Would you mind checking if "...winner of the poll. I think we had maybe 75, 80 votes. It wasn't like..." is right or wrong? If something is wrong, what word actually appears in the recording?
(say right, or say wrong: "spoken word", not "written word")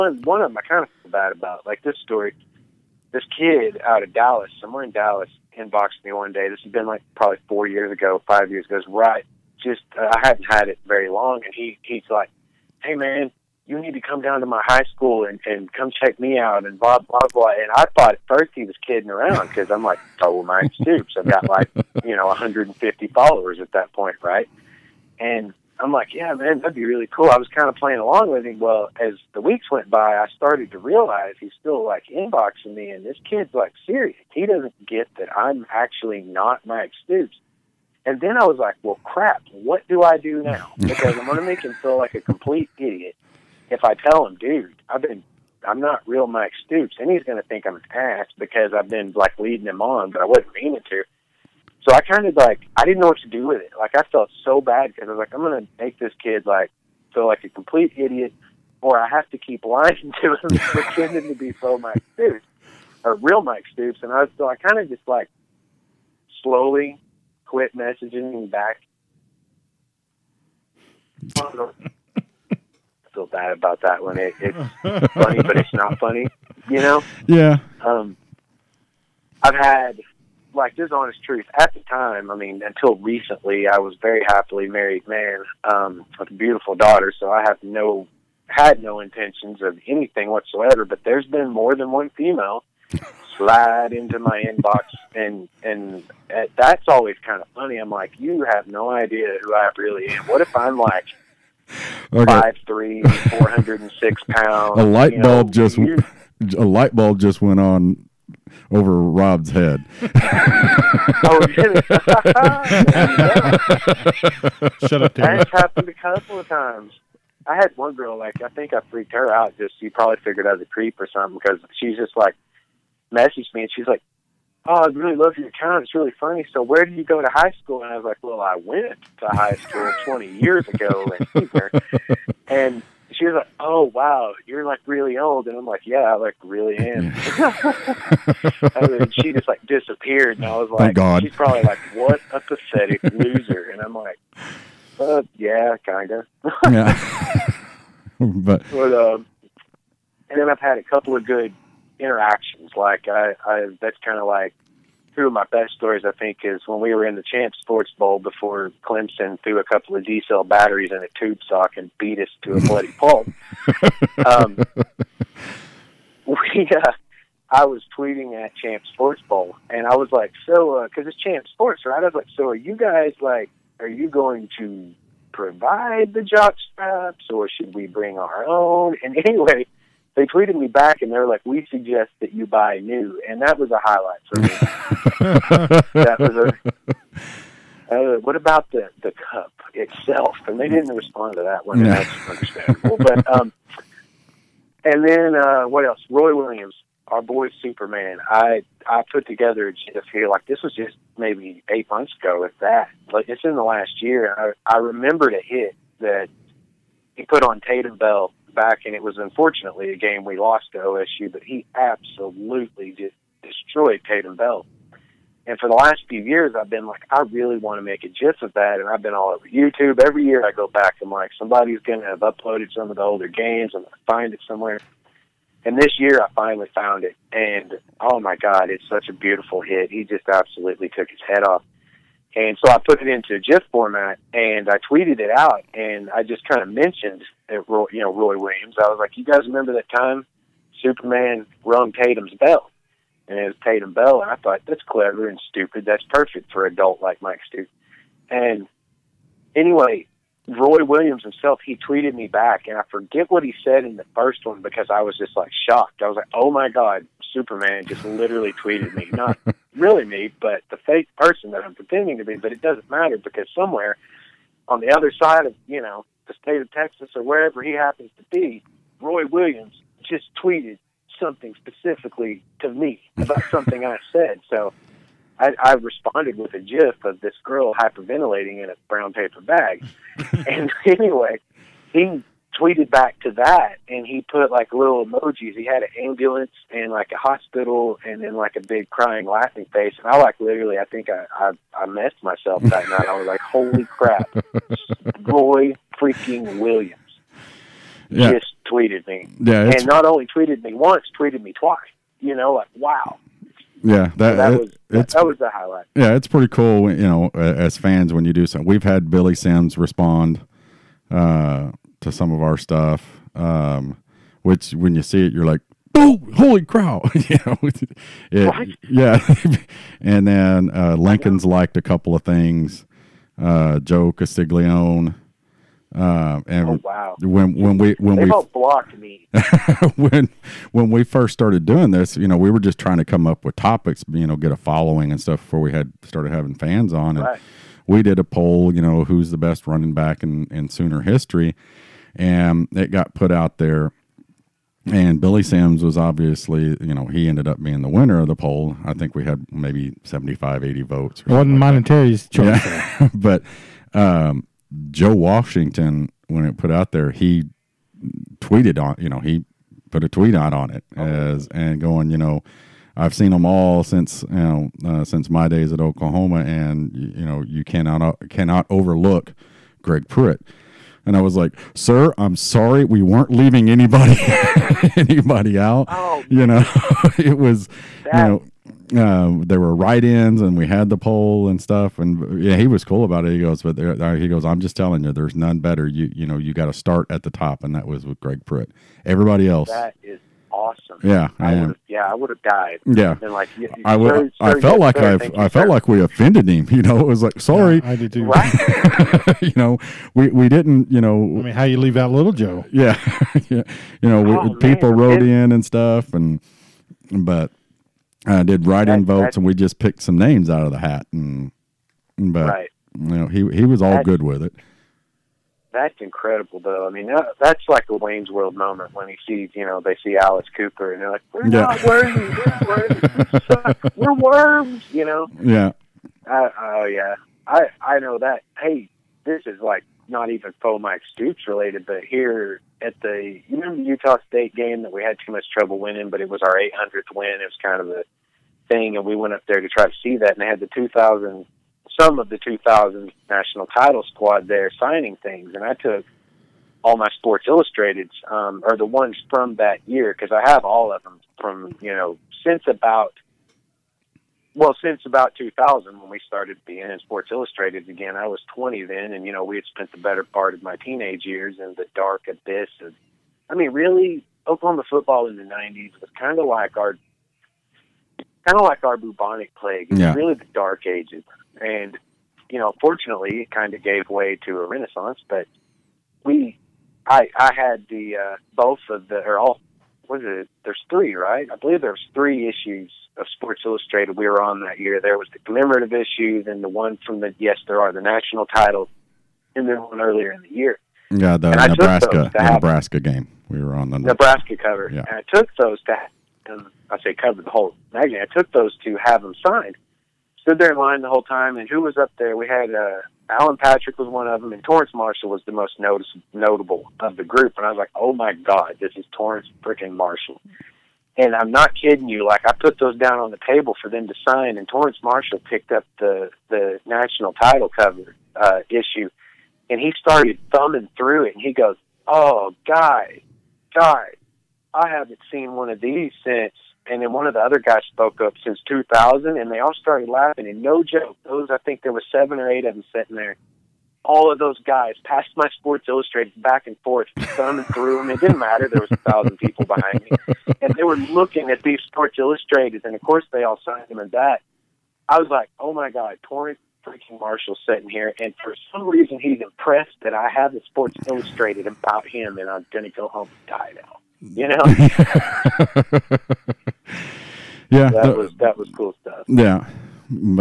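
right.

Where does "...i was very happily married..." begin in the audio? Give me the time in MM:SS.
01:23.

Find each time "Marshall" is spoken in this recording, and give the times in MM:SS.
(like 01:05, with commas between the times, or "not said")
08:24, 08:29, 08:35, 09:07.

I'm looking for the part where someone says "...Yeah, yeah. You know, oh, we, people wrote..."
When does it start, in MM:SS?
06:42.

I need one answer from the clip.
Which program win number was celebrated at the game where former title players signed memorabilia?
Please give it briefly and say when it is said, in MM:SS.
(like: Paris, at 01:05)
800th, at 07:16.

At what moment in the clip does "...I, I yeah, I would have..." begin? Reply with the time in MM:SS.
06:31.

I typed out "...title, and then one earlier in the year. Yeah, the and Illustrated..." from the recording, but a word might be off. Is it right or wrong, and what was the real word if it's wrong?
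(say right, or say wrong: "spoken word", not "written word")
wrong: "Nebraska", not "Illustrated".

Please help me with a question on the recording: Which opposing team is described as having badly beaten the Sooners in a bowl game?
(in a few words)
Clemson.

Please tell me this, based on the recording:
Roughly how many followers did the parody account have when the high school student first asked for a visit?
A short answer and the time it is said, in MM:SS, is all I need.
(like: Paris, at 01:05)
150, at 00:22.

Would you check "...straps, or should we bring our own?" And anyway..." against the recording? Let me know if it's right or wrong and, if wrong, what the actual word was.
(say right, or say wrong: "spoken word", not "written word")
right.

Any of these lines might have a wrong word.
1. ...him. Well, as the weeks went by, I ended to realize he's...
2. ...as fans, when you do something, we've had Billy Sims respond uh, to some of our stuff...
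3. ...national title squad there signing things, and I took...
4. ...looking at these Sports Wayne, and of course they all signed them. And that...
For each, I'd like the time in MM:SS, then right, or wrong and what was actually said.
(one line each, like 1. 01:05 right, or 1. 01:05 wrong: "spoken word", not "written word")
1. 00:28 wrong: "started", not "ended"
2. 05:07 right
3. 07:23 right
4. 09:00 wrong: "Illustrateds", not "Wayne".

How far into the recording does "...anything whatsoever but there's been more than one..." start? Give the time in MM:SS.
01:29.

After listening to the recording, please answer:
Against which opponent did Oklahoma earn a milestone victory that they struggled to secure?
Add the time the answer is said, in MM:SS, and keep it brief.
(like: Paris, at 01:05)
Utah State, at 07:13.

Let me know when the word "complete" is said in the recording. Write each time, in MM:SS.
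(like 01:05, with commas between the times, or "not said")
00:42, 00:57.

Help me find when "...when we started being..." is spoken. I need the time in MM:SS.
07:35.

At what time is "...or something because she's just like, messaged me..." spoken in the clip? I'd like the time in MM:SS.
02:00.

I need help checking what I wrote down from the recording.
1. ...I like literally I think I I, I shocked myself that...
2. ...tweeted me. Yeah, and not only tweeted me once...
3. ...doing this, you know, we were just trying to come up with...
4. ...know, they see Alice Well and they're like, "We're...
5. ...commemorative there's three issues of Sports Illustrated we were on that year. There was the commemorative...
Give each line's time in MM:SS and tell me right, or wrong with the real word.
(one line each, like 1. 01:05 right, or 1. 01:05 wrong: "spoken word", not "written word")
1. 04:50 wrong: "messed", not "shocked"
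2. 04:58 right
3. 05:31 right
4. 06:59 wrong: "Cooper", not "Well"
5. 08:01 wrong: "believe", not "commemorative".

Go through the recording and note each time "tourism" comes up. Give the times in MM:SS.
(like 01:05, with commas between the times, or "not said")
not said.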